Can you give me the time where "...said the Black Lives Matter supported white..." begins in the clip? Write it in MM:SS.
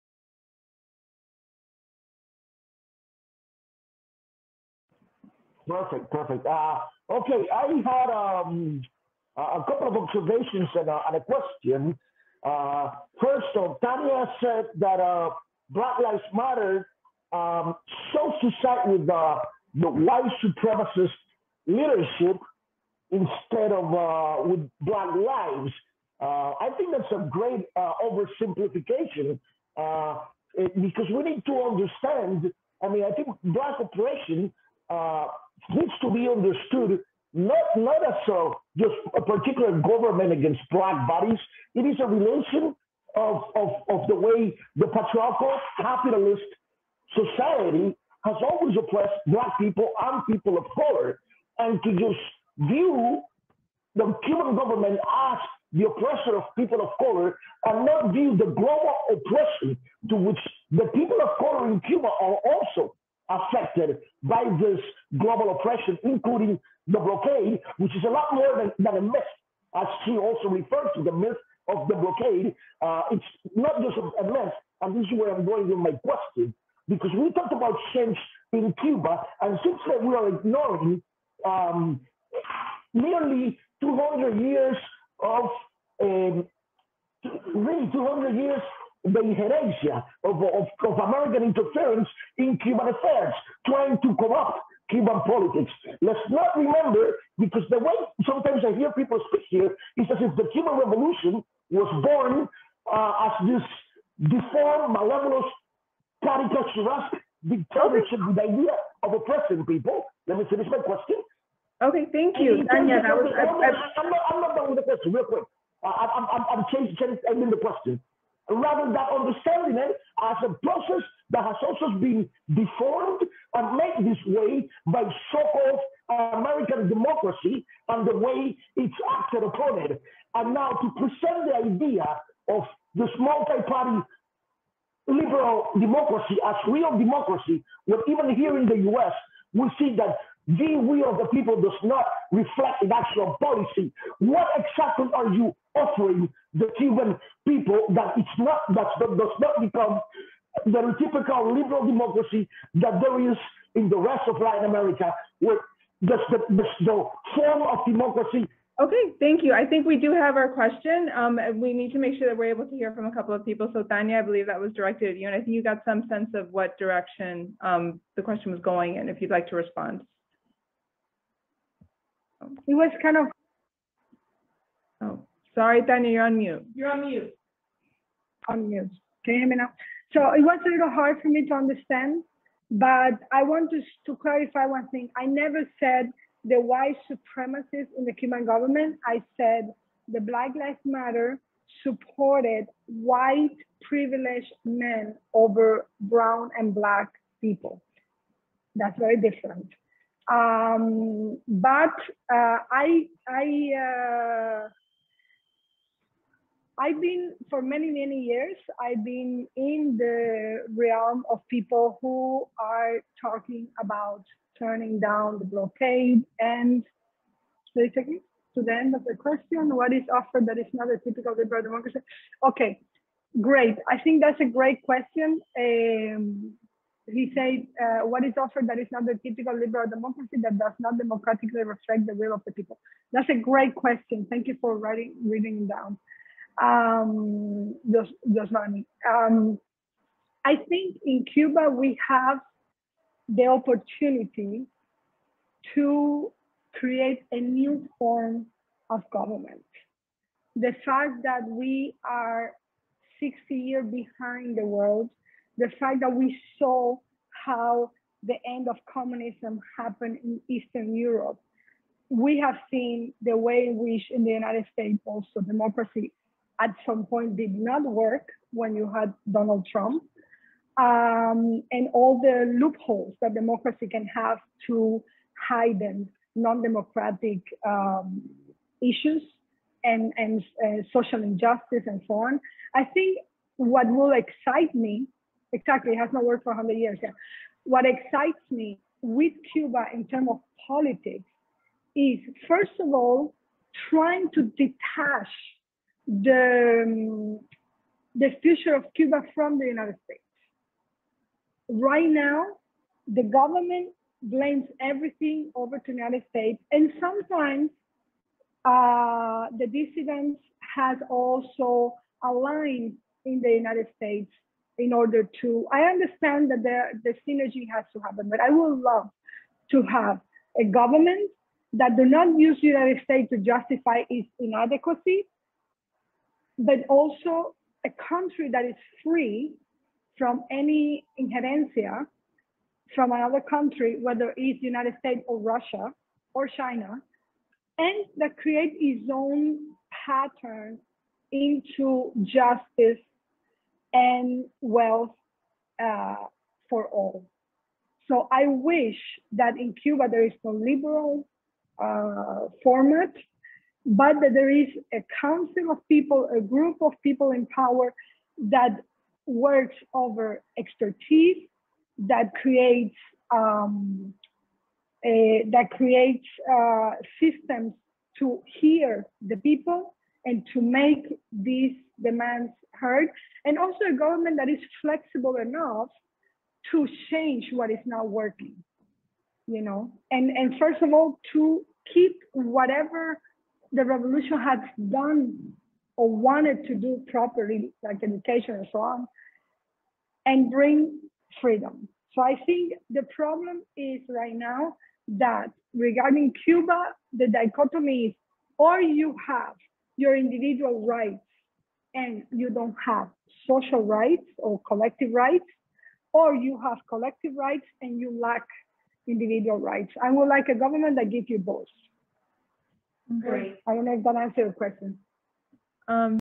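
03:09.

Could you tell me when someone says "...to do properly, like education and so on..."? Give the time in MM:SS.
06:26.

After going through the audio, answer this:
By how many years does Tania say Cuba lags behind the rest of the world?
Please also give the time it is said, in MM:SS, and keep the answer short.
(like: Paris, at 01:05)
60 years, at 04:13.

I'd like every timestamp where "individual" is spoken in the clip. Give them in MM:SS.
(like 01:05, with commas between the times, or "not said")
06:40, 06:49.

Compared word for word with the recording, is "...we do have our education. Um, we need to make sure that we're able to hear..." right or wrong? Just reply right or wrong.
wrong.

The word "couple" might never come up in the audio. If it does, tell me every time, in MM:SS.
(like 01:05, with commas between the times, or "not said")
00:09, 02:43.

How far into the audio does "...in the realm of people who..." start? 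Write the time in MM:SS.
03:29.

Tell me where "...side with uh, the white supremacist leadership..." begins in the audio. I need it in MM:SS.
00:18.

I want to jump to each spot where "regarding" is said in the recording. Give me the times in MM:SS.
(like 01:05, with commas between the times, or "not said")
06:35.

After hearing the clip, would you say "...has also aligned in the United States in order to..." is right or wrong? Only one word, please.
right.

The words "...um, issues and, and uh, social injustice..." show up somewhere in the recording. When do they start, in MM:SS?
04:37.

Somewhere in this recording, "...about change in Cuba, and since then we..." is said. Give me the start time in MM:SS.
01:17.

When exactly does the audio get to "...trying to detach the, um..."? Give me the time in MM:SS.
04:53.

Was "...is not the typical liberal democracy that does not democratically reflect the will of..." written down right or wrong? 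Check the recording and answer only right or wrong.
right.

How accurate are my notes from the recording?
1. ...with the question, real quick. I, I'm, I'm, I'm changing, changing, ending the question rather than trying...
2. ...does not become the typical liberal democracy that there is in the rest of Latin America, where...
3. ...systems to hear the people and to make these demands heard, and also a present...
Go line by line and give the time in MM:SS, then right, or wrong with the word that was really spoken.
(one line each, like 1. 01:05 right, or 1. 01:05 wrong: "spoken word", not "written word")
1. 01:54 wrong: "understanding", not "trying"
2. 02:28 right
3. 06:07 wrong: "government", not "present".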